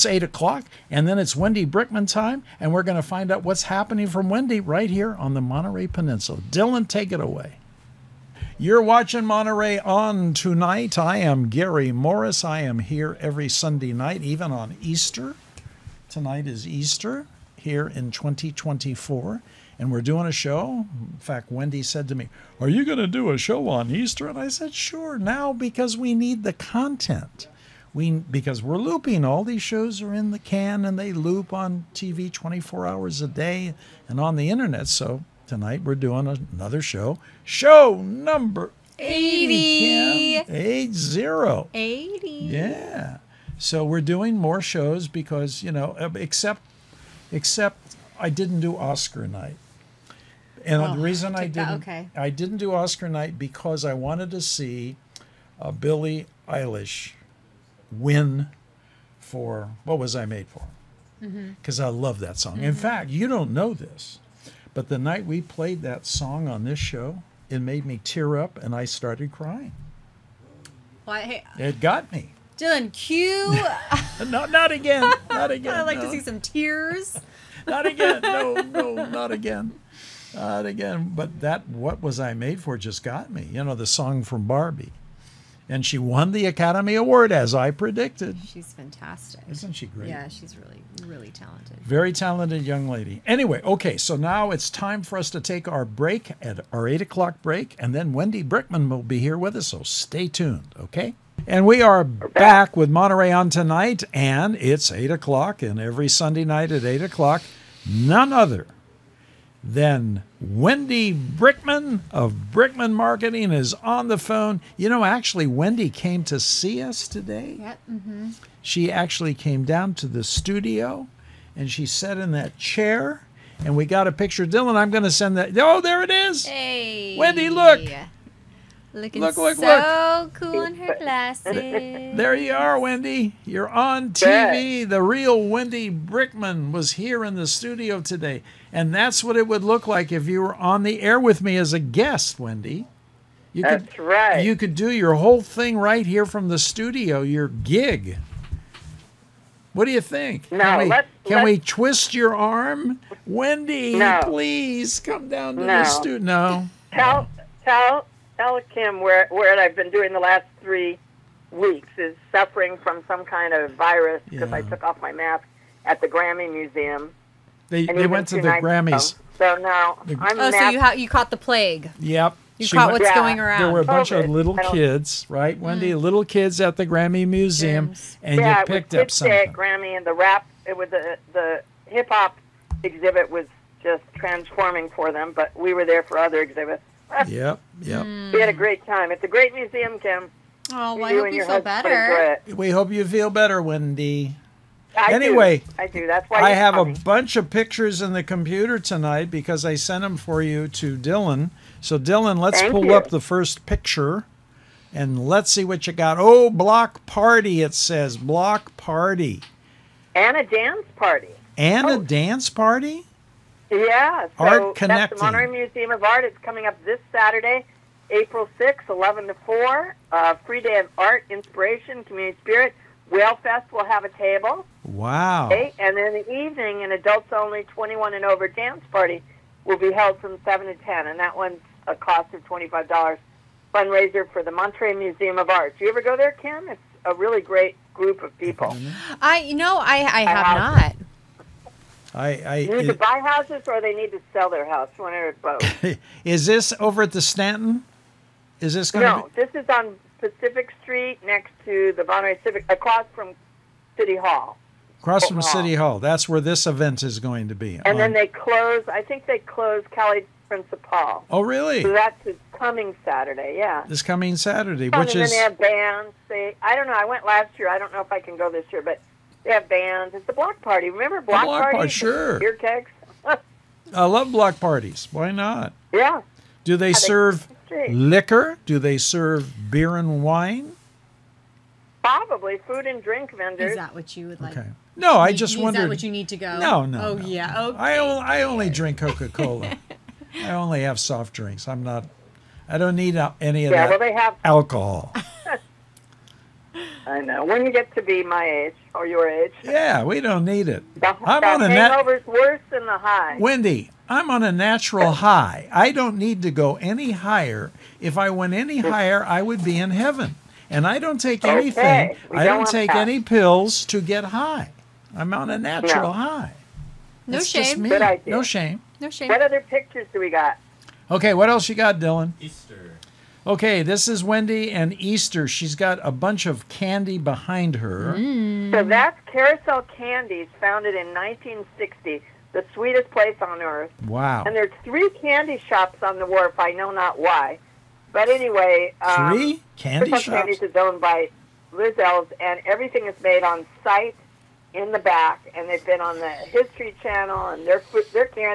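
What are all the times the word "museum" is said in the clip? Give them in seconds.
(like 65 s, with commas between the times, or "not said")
166 s, 177 s, 189 s, 215 s, 234 s.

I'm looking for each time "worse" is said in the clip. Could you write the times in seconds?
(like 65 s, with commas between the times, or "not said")
302 s.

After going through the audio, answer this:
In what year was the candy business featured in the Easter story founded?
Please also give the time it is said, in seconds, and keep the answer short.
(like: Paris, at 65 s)
1960, at 331 s.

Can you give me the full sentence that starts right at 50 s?
And oh, the reason I, I didn't okay.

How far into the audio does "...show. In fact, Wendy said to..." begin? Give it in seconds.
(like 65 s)
20 s.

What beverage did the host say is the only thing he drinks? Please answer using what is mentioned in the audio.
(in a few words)
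Coca Cola.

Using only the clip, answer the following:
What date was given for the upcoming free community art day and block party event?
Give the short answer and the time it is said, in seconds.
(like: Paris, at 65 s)
April 6th, at 218 s.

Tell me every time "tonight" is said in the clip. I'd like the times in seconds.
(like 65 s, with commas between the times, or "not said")
10 s, 16 s, 35 s, 103 s, 198 s.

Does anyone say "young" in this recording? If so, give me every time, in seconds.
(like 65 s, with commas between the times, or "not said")
92 s.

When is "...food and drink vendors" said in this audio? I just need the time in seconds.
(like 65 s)
282 s.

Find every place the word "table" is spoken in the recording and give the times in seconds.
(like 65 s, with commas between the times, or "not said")
224 s.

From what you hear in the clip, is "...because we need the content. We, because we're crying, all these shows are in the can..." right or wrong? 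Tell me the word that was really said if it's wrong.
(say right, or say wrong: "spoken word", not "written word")
wrong: "looping", not "crying".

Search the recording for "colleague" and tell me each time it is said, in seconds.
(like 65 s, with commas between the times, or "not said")
not said.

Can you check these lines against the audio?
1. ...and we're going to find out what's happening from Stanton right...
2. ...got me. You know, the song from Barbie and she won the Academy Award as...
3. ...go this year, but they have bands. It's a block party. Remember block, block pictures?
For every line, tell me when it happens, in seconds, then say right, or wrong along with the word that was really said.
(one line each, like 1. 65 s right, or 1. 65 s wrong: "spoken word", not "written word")
1. 2 s wrong: "Wendy", not "Stanton"
2. 83 s right
3. 268 s wrong: "parties", not "pictures".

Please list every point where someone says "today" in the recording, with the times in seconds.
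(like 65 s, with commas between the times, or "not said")
117 s, 138 s.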